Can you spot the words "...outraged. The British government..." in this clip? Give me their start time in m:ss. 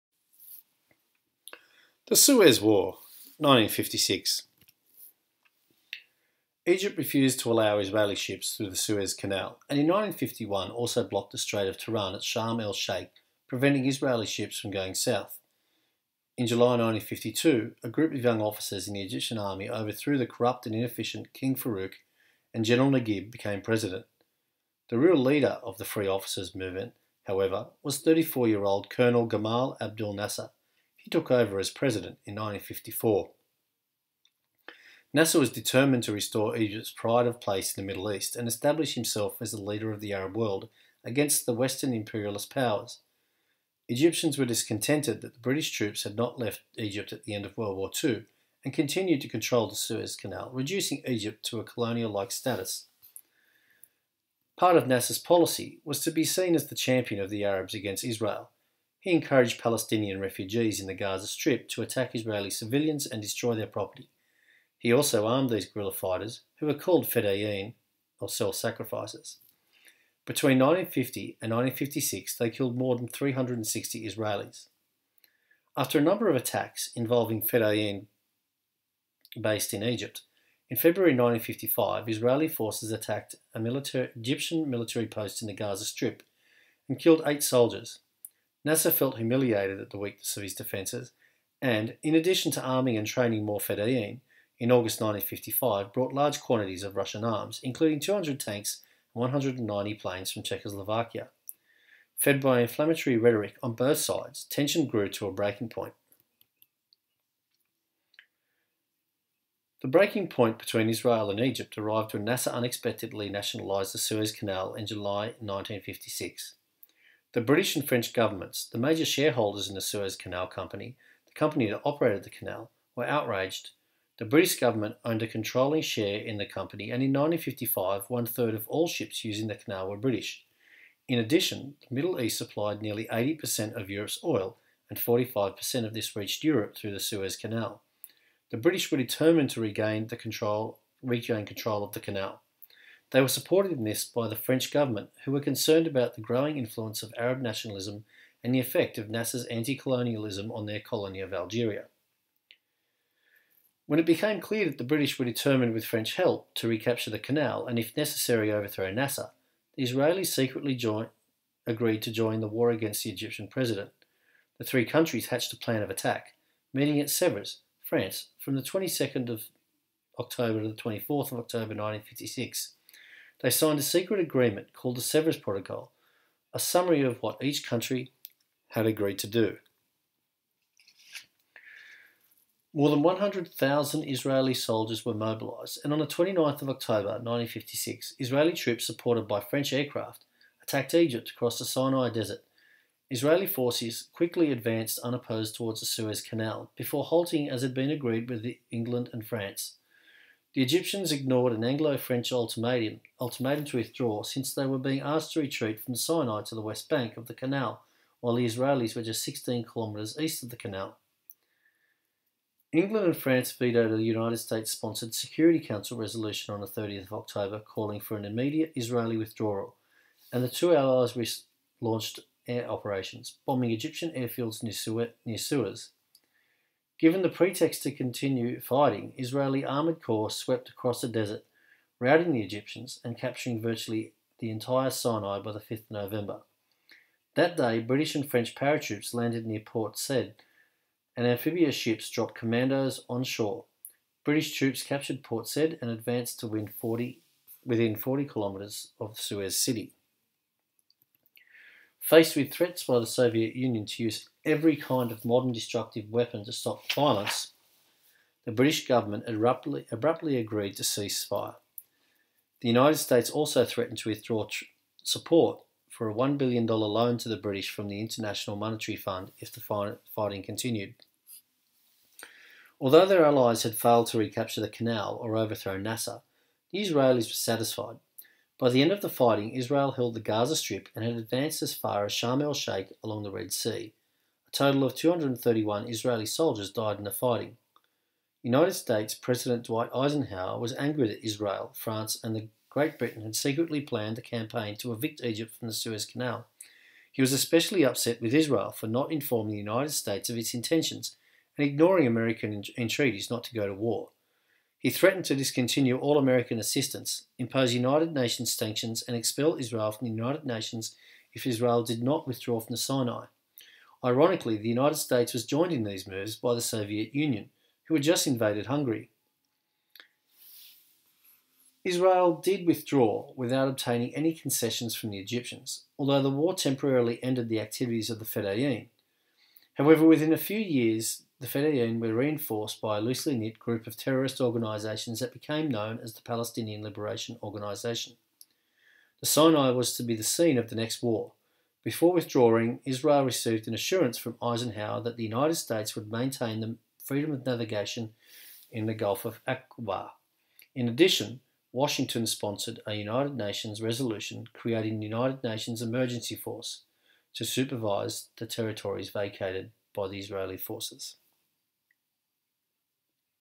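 2:03.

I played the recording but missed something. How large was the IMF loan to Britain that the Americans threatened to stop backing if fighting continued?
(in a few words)
$1 billion.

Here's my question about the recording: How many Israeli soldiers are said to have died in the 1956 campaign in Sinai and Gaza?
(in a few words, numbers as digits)
231.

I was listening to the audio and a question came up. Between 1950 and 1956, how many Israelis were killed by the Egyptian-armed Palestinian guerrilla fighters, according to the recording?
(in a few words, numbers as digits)
more than 360.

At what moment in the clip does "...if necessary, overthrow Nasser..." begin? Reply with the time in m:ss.
2:37.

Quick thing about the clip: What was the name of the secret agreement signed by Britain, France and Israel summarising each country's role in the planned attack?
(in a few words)
Sevres Protocol.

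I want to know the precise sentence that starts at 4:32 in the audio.
Although their allies had failed to recapture the canal or overthrow Nasser, the Israelis were satisfied.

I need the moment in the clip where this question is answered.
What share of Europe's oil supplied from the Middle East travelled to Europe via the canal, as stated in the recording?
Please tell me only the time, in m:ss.
2:14.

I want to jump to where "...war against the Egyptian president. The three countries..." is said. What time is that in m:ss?
2:42.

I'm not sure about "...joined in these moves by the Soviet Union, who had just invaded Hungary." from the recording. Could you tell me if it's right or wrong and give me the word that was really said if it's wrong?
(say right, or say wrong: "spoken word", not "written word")
right.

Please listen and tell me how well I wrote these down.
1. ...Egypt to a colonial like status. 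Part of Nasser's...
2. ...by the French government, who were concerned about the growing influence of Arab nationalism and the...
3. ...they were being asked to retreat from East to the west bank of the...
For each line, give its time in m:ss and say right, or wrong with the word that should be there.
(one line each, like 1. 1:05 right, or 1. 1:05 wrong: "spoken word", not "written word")
1. 0:51 right
2. 2:24 right
3. 3:24 wrong: "Sinai", not "East".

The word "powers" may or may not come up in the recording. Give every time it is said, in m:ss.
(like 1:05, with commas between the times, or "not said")
0:42.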